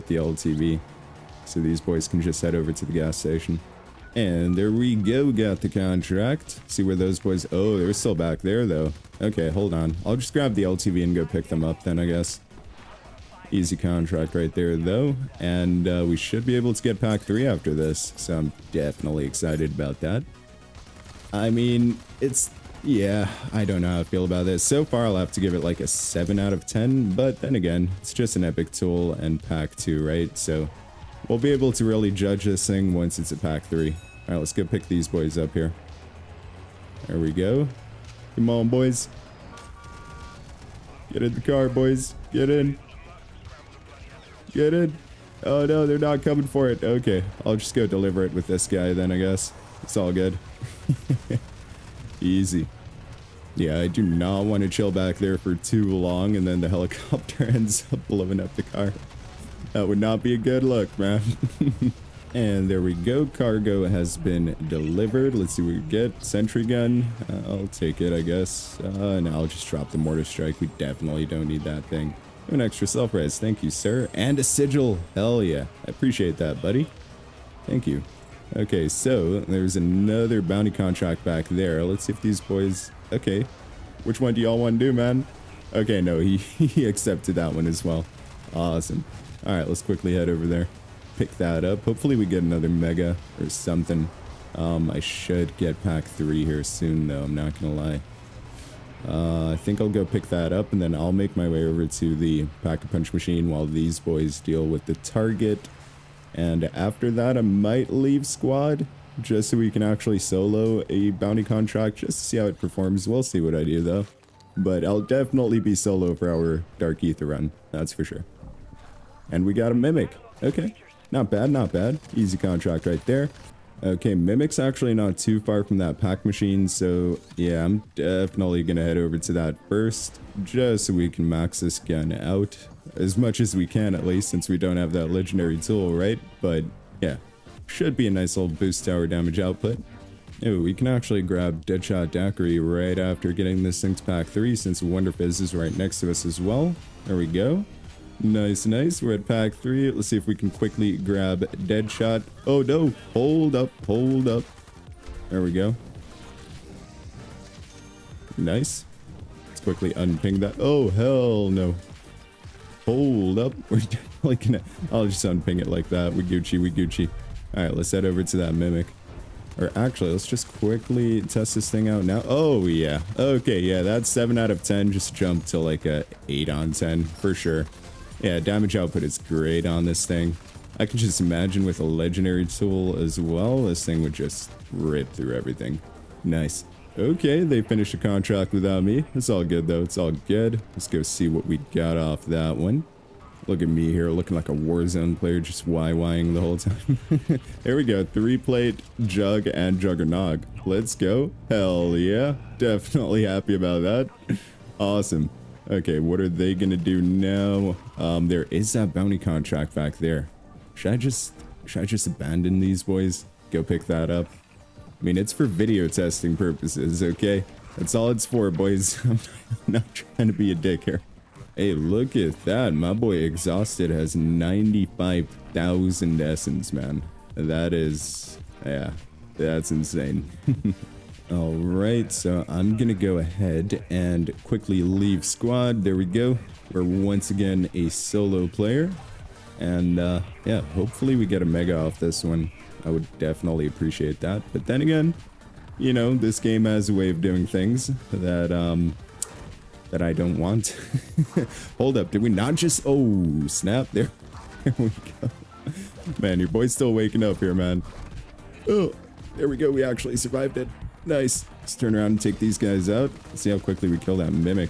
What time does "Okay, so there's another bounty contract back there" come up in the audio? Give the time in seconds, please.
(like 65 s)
78 s.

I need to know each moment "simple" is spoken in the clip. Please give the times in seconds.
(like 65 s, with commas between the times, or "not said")
not said.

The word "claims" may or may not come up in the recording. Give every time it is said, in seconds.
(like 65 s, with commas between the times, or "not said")
not said.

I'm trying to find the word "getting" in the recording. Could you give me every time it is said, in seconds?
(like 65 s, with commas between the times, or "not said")
143 s.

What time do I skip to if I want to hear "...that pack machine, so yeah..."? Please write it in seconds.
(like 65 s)
125 s.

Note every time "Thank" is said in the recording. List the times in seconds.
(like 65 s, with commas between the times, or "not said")
73 s, 77 s.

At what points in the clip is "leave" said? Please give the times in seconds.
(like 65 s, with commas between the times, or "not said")
107 s, 234 s.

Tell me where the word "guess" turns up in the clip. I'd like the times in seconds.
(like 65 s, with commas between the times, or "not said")
12 s, 49 s, 68 s.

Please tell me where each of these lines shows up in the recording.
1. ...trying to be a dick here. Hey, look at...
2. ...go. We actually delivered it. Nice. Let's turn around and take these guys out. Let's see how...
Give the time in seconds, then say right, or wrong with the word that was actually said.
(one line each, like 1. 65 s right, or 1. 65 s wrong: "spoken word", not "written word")
1. 219 s right
2. 259 s wrong: "survived", not "delivered".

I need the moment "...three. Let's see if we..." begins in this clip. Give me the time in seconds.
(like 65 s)
149 s.